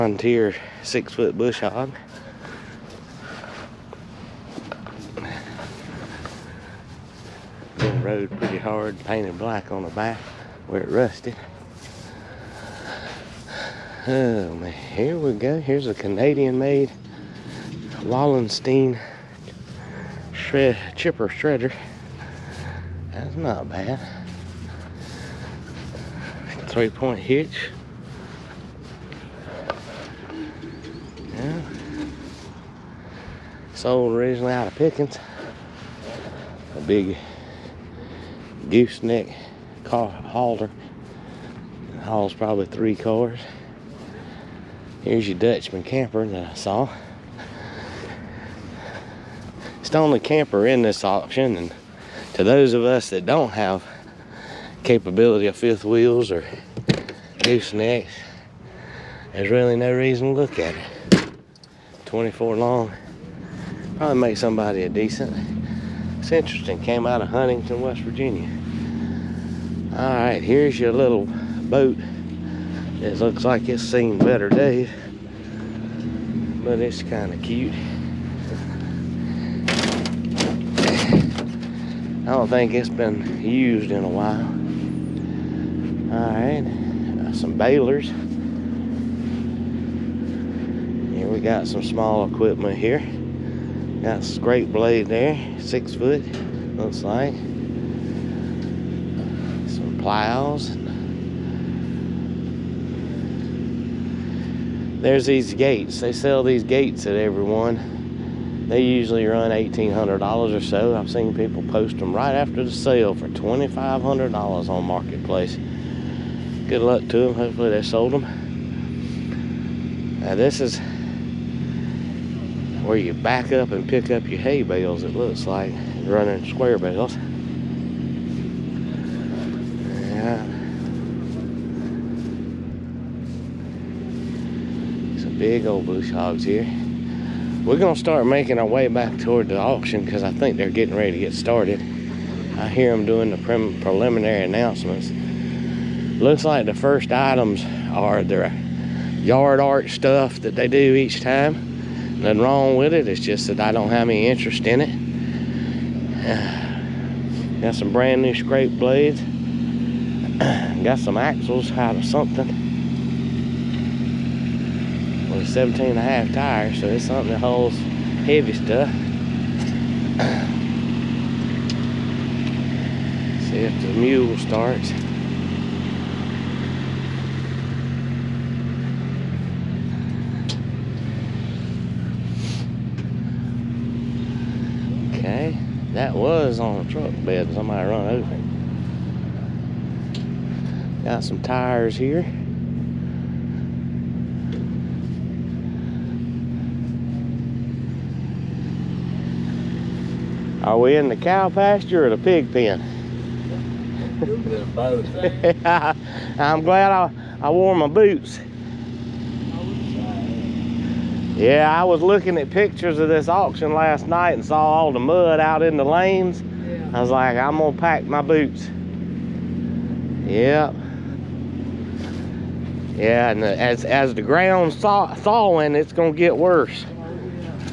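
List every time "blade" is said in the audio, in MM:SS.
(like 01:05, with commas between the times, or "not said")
01:34, 02:38.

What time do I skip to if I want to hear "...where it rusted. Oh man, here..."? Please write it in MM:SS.
00:10.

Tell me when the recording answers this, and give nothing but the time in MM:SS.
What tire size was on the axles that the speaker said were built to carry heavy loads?
02:45.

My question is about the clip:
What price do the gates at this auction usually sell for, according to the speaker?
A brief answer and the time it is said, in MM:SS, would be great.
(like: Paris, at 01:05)
$1,800, at 01:49.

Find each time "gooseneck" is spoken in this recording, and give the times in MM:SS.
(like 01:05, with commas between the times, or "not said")
00:38, 00:57.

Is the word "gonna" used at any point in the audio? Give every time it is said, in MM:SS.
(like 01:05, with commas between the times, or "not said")
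02:17, 03:37, 03:45.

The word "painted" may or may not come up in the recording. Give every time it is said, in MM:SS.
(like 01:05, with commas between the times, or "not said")
00:09.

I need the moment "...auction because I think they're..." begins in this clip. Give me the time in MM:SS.
02:19.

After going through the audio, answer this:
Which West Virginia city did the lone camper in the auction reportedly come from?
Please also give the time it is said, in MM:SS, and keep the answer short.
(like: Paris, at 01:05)
Huntington, at 01:07.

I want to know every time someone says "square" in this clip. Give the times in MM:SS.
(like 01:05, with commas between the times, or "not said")
02:06.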